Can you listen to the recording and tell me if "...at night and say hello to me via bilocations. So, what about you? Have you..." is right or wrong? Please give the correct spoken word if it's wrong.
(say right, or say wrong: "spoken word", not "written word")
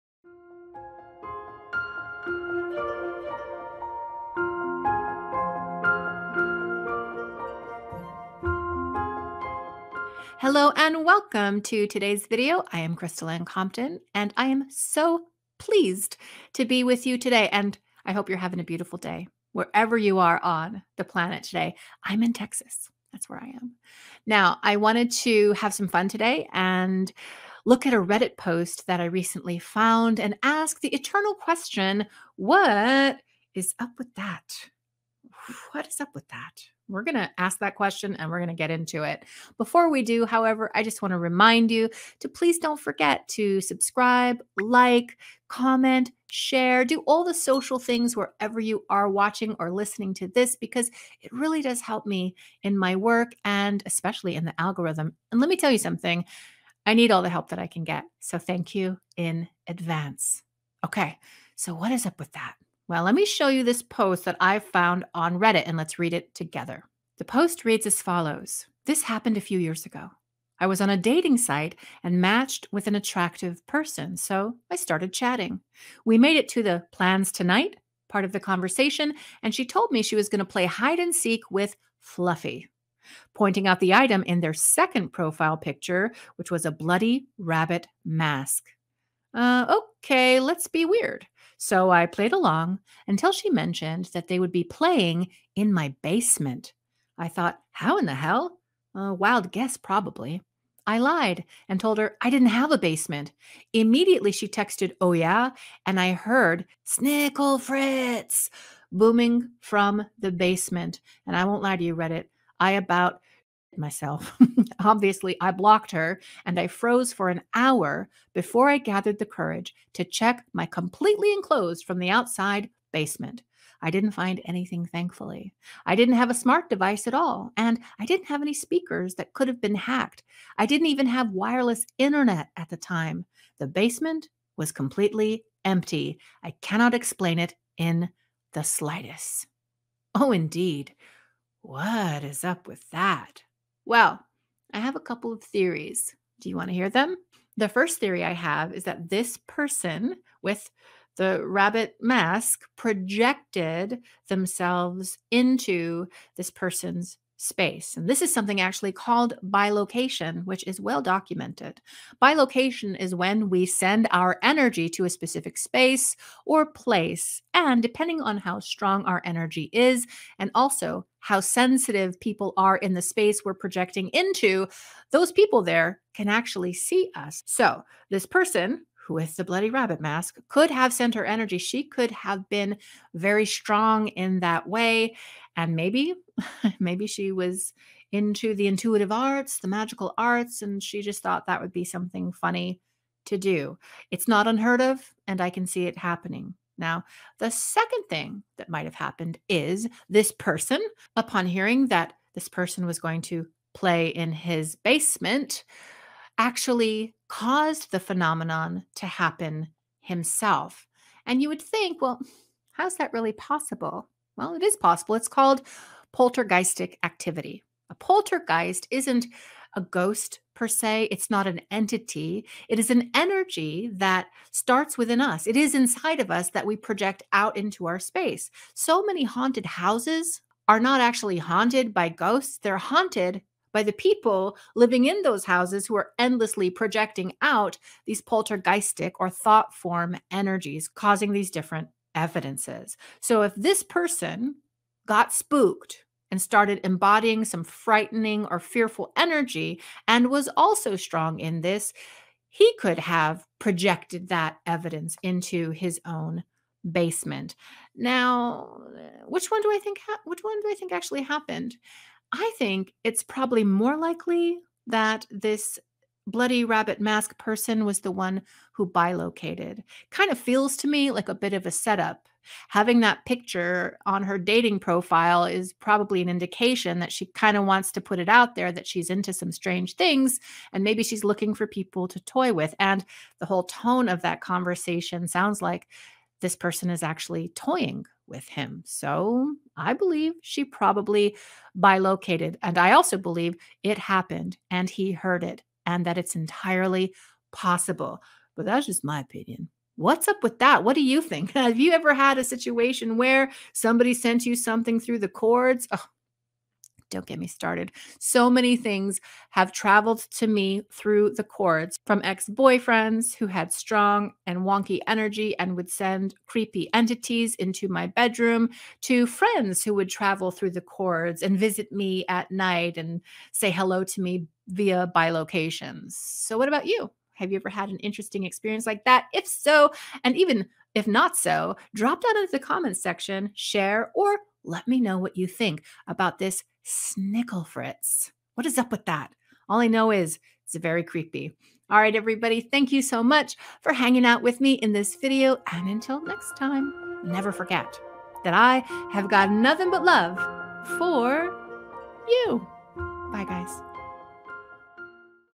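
right.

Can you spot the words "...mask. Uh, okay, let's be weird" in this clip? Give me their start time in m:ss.
1:28.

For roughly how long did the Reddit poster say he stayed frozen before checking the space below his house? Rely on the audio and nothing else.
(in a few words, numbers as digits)
an hour.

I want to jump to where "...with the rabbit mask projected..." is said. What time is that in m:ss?
2:30.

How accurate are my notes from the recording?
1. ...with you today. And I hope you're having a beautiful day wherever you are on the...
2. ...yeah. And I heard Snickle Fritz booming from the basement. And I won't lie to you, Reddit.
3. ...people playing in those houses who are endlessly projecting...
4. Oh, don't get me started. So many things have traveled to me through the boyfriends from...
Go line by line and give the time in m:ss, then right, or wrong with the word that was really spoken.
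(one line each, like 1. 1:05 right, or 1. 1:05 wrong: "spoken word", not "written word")
1. 0:16 right
2. 1:45 right
3. 3:53 wrong: "living", not "playing"
4. 5:05 wrong: "cords", not "boyfriends".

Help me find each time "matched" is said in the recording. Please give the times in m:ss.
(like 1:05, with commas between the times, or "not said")
1:12.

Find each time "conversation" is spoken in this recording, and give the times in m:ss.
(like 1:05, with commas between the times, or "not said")
1:18, 4:44.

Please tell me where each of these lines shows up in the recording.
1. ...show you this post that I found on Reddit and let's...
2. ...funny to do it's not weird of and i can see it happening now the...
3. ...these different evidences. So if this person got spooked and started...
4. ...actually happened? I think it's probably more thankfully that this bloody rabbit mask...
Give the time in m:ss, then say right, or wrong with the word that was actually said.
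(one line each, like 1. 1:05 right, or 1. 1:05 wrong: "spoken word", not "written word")
1. 1:03 right
2. 3:12 wrong: "unheard", not "weird"
3. 4:01 right
4. 4:20 wrong: "likely", not "thankfully".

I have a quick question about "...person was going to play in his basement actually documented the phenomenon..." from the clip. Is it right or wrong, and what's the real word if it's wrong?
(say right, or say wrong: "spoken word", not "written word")
wrong: "caused", not "documented".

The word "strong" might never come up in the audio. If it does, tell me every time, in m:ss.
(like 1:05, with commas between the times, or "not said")
2:48, 3:03, 4:10, 5:13.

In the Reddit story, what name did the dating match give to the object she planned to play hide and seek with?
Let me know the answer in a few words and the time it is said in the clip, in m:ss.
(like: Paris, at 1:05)
Fluffy, at 1:22.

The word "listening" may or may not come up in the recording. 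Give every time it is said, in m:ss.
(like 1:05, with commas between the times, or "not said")
0:49.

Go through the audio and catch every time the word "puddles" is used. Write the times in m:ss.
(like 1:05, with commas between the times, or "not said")
not said.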